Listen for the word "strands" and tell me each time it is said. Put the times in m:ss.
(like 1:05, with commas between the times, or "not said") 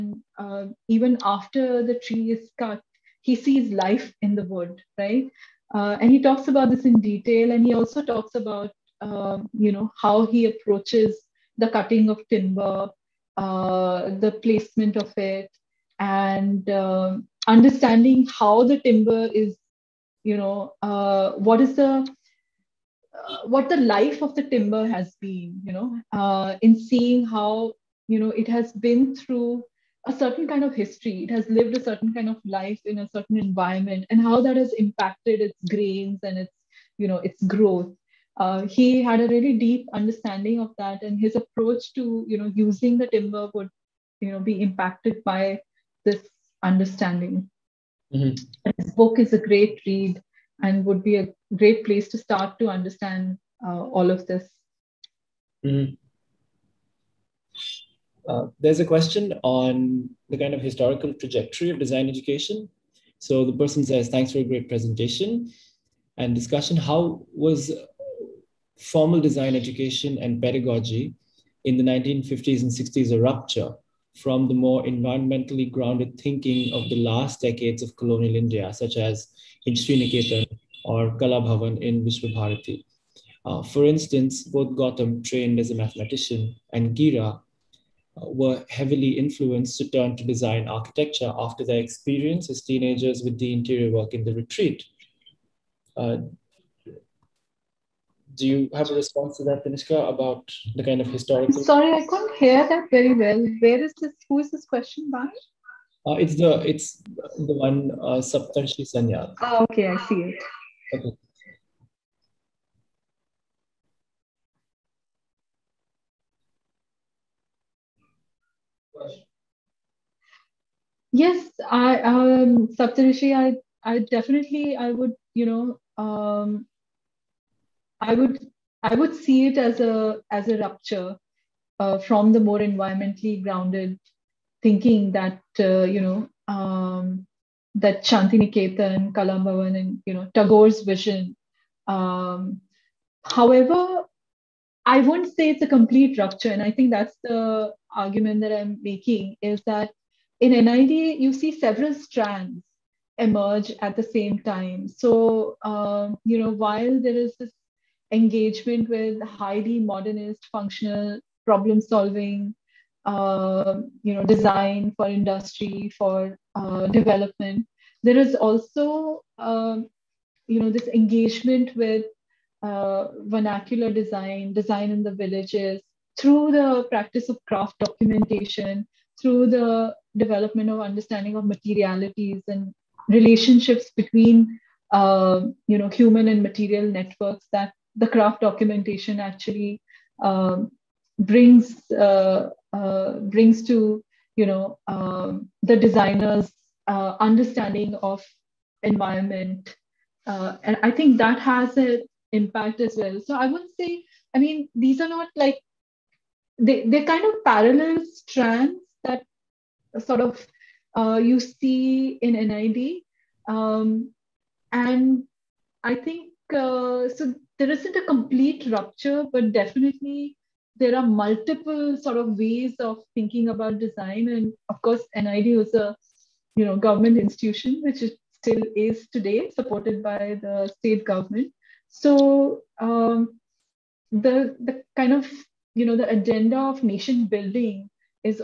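2:31, 3:28.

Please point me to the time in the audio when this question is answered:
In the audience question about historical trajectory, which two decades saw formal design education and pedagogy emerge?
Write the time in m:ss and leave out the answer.
1:11.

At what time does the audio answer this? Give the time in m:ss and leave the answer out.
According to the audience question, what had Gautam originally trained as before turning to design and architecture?
1:25.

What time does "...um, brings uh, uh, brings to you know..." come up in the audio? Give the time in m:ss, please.
3:10.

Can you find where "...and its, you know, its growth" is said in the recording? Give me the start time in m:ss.
0:36.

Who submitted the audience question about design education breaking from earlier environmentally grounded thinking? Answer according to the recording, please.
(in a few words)
Saptarshi Sanyal.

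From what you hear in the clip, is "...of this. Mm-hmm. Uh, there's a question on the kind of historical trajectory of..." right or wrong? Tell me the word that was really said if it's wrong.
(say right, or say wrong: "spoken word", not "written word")
right.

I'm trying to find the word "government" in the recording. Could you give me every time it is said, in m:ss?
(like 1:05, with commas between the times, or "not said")
3:46, 3:51.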